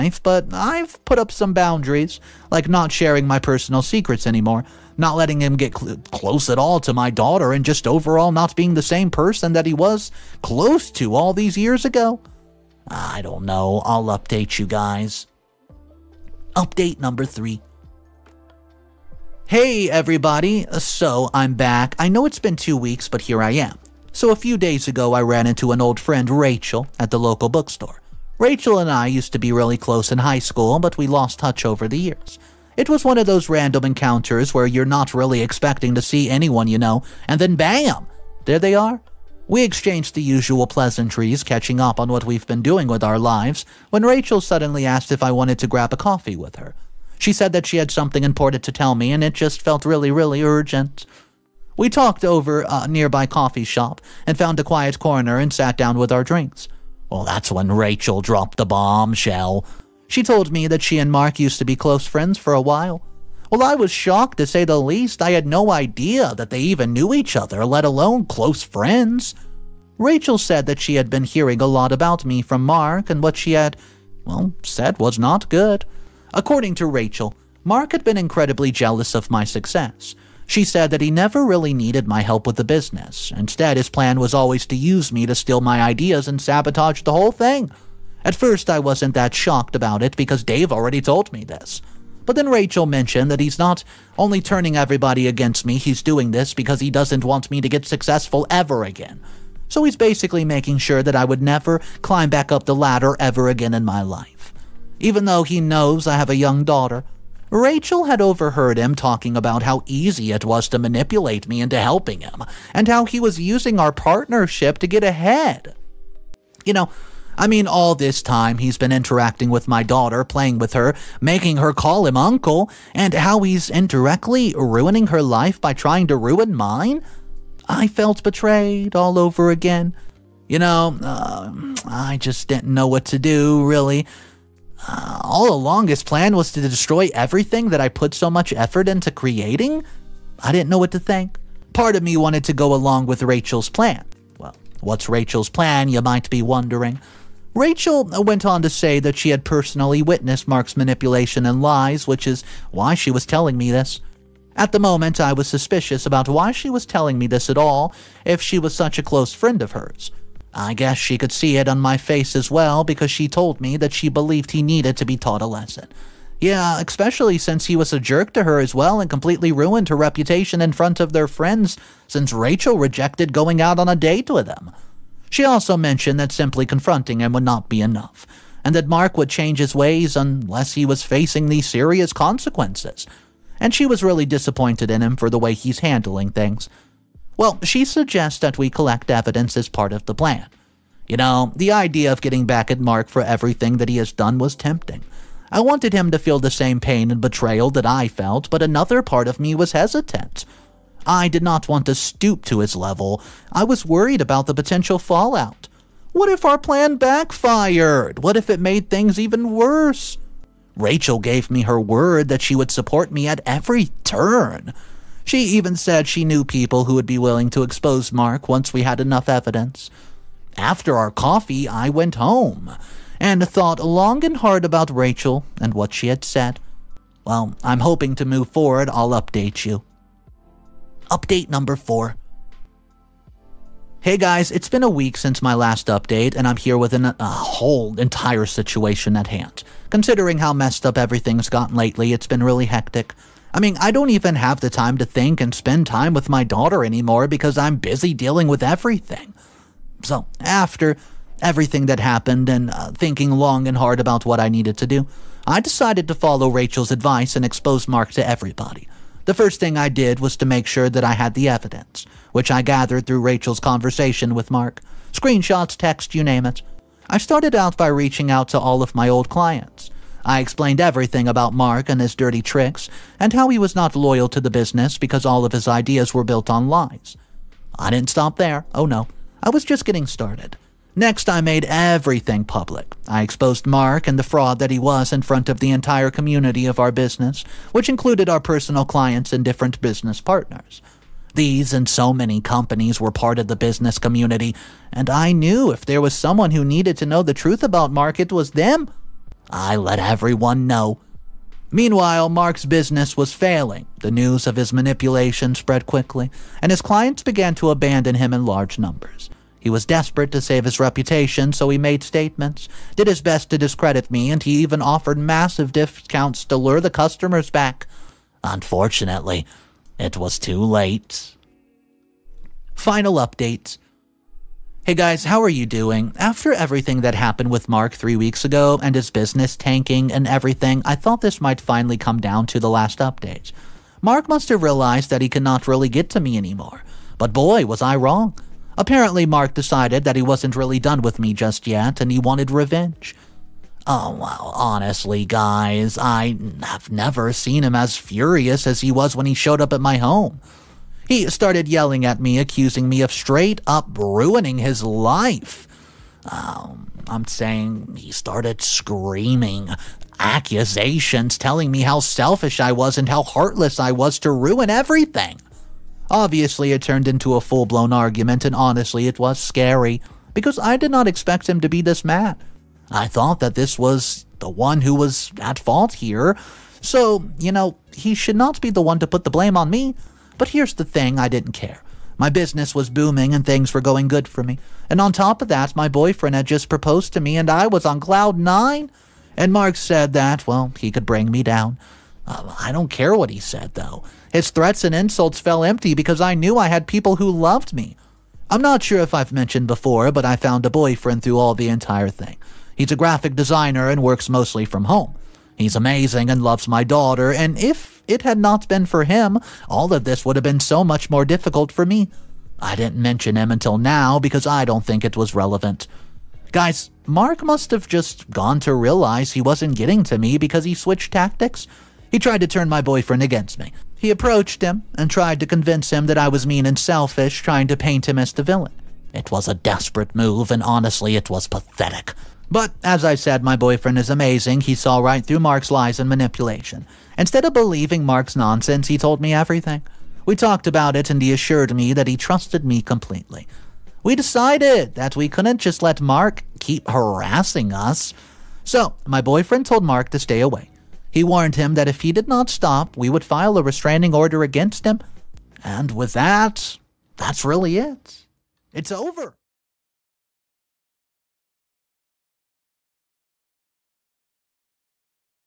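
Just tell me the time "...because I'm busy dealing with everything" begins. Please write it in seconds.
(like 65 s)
247 s.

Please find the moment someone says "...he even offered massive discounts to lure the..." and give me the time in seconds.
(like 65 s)
314 s.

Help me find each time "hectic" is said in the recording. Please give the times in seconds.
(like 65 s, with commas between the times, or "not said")
242 s.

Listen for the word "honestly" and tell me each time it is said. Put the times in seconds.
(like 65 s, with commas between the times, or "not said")
344 s, 368 s, 430 s.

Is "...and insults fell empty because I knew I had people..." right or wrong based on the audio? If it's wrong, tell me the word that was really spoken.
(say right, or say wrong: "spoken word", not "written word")
right.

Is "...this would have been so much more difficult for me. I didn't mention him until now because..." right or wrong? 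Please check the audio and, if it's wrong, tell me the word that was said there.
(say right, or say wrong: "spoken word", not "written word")
right.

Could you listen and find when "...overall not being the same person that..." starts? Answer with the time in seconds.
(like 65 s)
7 s.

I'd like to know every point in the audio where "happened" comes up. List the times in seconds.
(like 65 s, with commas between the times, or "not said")
251 s, 327 s.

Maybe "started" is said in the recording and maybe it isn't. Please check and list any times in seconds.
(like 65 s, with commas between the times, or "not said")
267 s, 280 s, 351 s, 358 s.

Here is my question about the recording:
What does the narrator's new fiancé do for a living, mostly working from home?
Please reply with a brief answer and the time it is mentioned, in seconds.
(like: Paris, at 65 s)
graphic designer, at 402 s.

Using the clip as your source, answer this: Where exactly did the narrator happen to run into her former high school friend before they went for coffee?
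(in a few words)
local bookstore.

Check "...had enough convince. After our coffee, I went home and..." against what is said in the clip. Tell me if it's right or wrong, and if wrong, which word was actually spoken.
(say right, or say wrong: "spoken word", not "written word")
wrong: "evidence", not "convince".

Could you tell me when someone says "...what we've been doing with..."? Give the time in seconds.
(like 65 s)
42 s.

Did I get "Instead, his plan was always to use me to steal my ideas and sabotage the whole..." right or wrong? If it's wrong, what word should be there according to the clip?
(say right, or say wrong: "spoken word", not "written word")
right.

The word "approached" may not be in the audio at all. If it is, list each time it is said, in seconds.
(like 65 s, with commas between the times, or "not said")
424 s.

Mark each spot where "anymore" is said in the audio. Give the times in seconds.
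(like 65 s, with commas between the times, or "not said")
4 s, 246 s, 336 s.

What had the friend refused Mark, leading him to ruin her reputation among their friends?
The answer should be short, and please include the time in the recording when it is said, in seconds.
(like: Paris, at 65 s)
going out on a date, at 173 s.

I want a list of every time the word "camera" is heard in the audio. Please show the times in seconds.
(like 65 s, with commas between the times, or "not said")
not said.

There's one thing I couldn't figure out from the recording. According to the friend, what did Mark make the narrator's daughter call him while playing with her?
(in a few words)
uncle.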